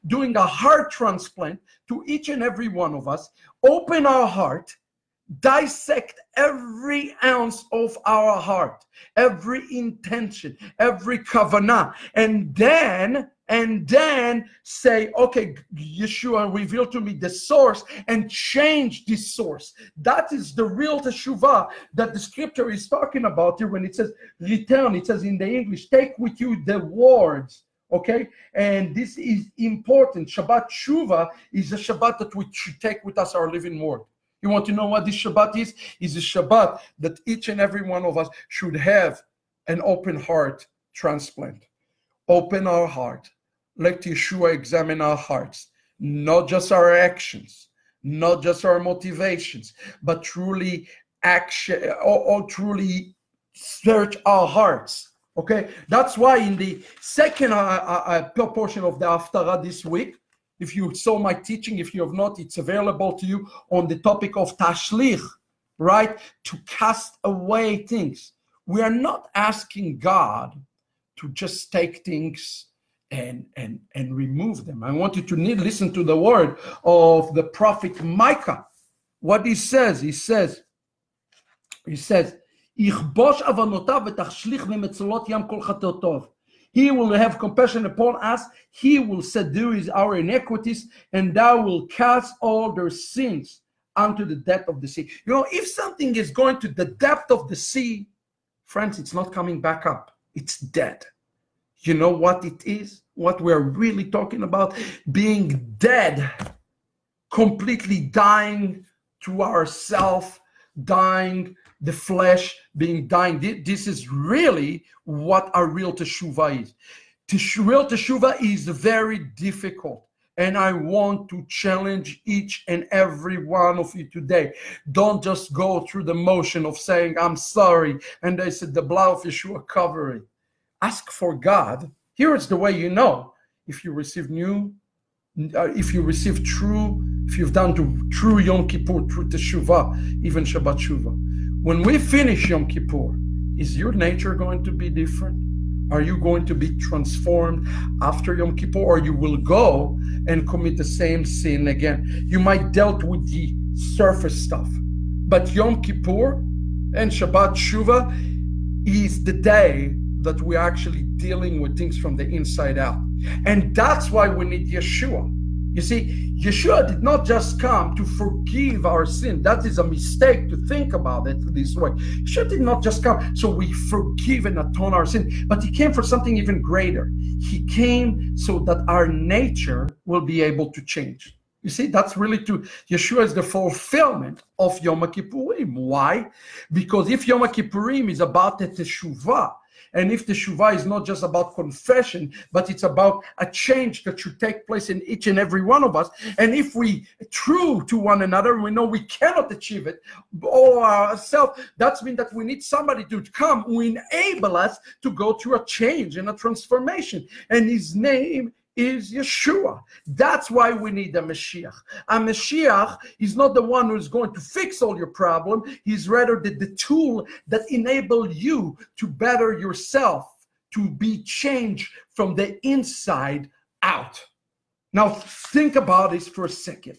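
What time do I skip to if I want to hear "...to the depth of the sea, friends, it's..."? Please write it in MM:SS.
01:36.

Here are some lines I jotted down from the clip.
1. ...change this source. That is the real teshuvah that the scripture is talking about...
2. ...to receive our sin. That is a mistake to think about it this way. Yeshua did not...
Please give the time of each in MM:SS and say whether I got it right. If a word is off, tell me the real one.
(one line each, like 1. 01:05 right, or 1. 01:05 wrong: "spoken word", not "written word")
1. 00:18 right
2. 02:47 wrong: "forgive", not "receive".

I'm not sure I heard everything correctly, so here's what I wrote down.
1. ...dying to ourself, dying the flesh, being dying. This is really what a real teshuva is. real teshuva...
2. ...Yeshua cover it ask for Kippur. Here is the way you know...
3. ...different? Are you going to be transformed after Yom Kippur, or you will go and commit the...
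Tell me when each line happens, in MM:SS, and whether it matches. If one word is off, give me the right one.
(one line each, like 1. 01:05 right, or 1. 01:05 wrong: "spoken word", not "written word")
1. 01:48 right
2. 02:09 wrong: "God", not "Kippur"
3. 02:24 right.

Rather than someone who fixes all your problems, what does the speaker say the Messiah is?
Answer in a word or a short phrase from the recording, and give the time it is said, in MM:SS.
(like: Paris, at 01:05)
the tool, at 03:36.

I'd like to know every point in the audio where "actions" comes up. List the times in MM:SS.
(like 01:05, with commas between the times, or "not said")
00:46, 00:51.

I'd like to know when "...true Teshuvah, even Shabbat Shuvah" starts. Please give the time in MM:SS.
02:19.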